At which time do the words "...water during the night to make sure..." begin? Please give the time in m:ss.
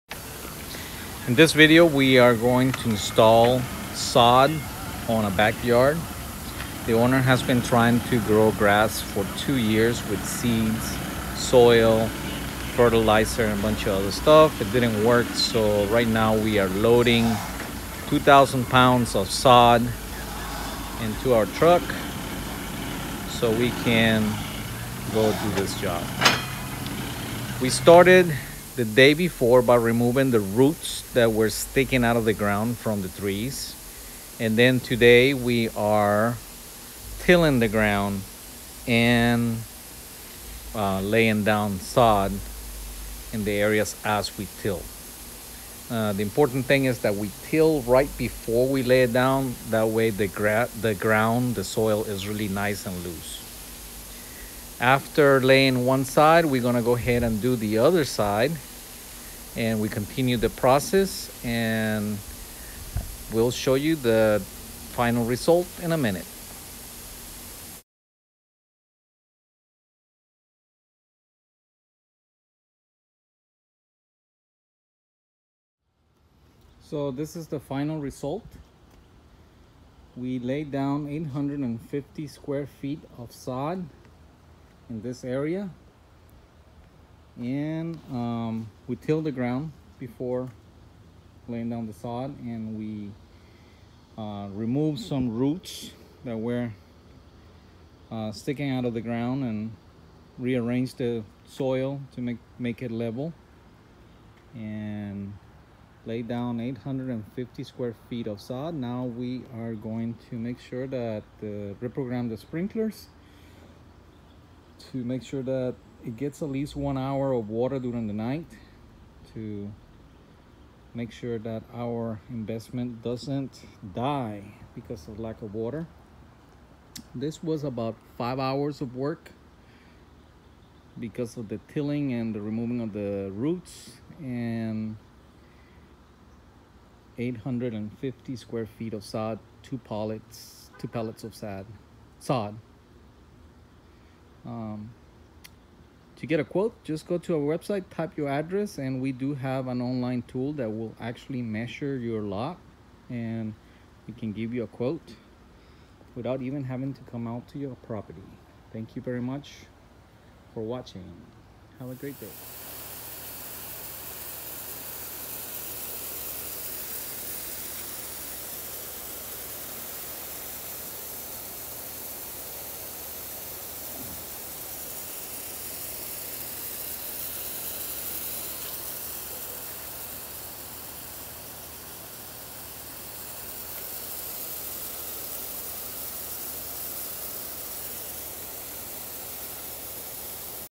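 1:57.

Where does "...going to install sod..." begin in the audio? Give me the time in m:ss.
0:02.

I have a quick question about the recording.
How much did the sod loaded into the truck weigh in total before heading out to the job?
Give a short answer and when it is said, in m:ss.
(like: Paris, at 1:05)
2,000 pounds, at 0:18.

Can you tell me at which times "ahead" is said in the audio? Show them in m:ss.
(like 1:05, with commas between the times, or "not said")
0:56.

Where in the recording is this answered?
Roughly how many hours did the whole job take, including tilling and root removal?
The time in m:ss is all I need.
2:08.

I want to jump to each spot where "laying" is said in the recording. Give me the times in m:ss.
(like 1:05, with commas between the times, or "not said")
0:41, 0:55, 1:31.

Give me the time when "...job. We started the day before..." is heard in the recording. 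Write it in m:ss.
0:25.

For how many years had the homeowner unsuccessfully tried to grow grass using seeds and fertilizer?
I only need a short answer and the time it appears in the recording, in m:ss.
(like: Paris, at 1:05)
2 years, at 0:09.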